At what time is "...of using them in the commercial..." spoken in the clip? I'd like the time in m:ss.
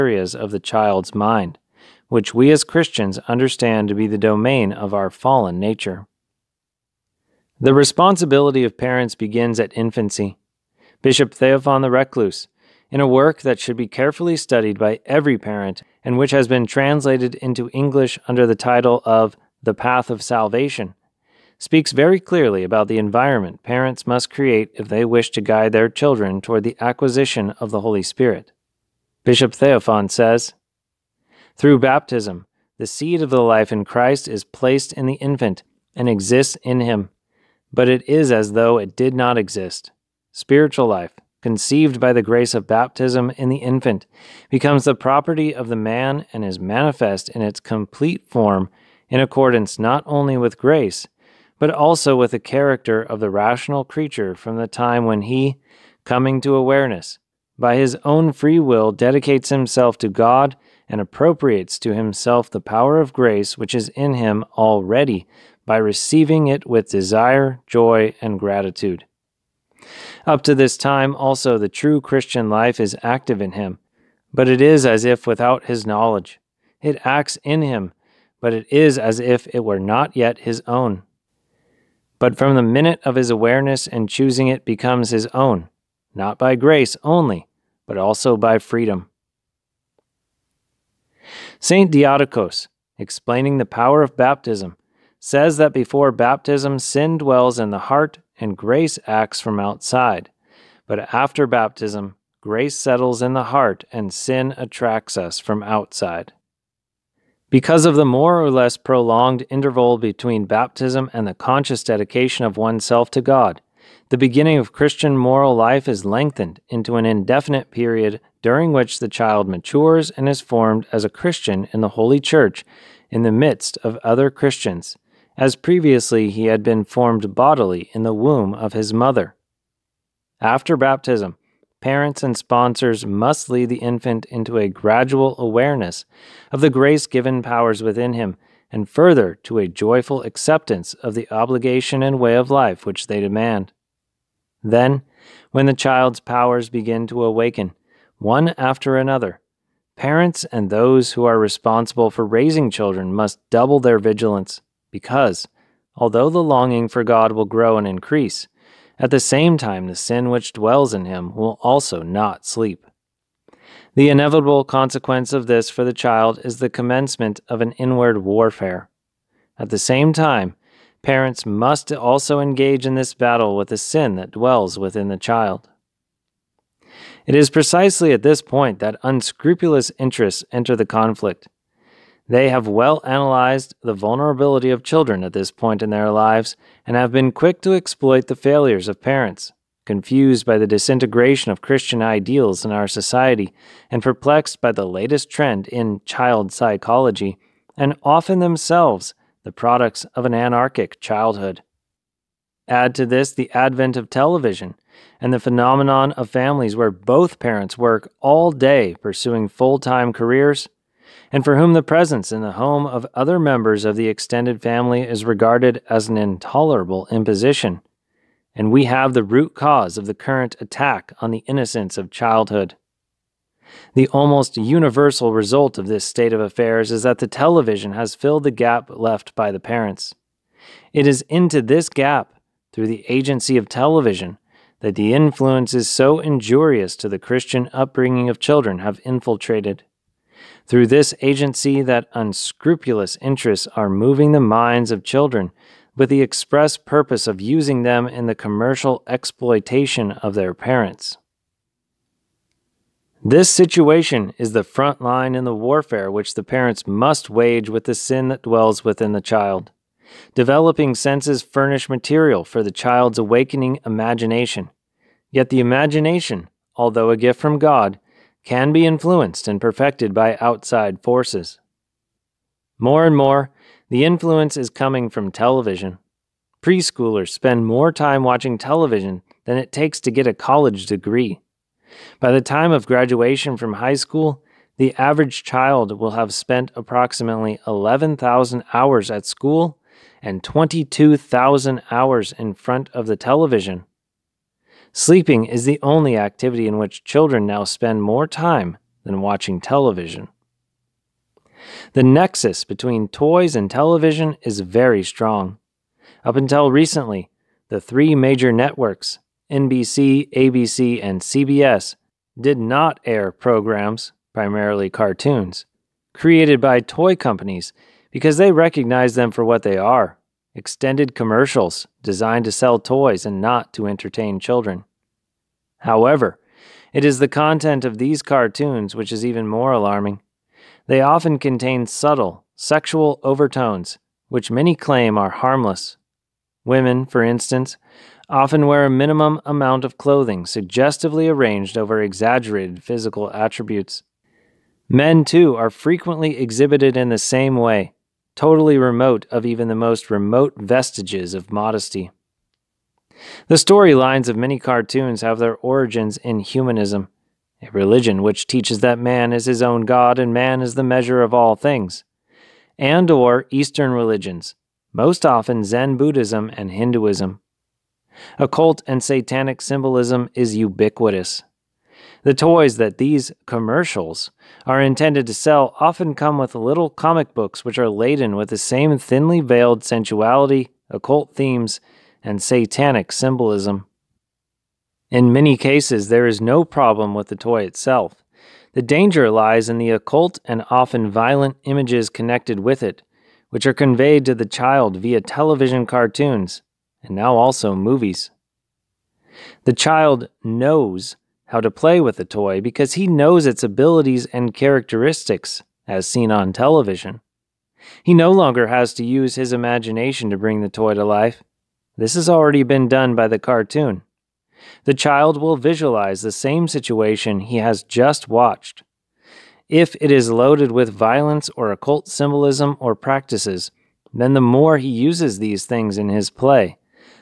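4:07.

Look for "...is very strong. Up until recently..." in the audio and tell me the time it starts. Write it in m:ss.
5:04.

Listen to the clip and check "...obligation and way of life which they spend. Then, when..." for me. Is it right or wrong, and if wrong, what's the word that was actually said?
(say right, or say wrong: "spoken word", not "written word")
wrong: "demand", not "spend".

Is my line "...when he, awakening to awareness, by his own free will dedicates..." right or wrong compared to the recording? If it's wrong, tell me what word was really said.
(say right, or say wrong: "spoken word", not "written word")
wrong: "coming", not "awakening".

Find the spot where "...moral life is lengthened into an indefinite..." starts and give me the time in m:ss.
1:55.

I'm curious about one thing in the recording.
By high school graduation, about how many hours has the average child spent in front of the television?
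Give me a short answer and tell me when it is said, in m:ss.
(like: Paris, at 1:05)
22,000, at 4:50.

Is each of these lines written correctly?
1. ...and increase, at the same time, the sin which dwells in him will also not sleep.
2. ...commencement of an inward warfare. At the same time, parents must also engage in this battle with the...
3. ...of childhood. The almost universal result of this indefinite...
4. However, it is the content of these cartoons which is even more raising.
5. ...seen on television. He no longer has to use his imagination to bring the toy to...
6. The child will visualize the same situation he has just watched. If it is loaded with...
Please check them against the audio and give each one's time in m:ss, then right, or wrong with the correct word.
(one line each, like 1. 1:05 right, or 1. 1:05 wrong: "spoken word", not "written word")
1. 2:37 right
2. 2:46 right
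3. 3:41 wrong: "state", not "indefinite"
4. 5:25 wrong: "alarming", not "raising"
5. 6:46 right
6. 6:54 right.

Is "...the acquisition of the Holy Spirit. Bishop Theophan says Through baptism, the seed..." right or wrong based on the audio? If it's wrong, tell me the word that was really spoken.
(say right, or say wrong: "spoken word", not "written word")
right.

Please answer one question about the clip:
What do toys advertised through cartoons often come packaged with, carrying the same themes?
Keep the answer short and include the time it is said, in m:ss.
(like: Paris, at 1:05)
Little comic books, at 6:16.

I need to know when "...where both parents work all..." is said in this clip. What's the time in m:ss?
3:26.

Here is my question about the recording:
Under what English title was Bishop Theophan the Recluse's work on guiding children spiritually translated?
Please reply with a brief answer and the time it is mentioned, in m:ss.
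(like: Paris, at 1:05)
The Path of Salvation, at 0:19.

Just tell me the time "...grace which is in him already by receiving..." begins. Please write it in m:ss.
1:03.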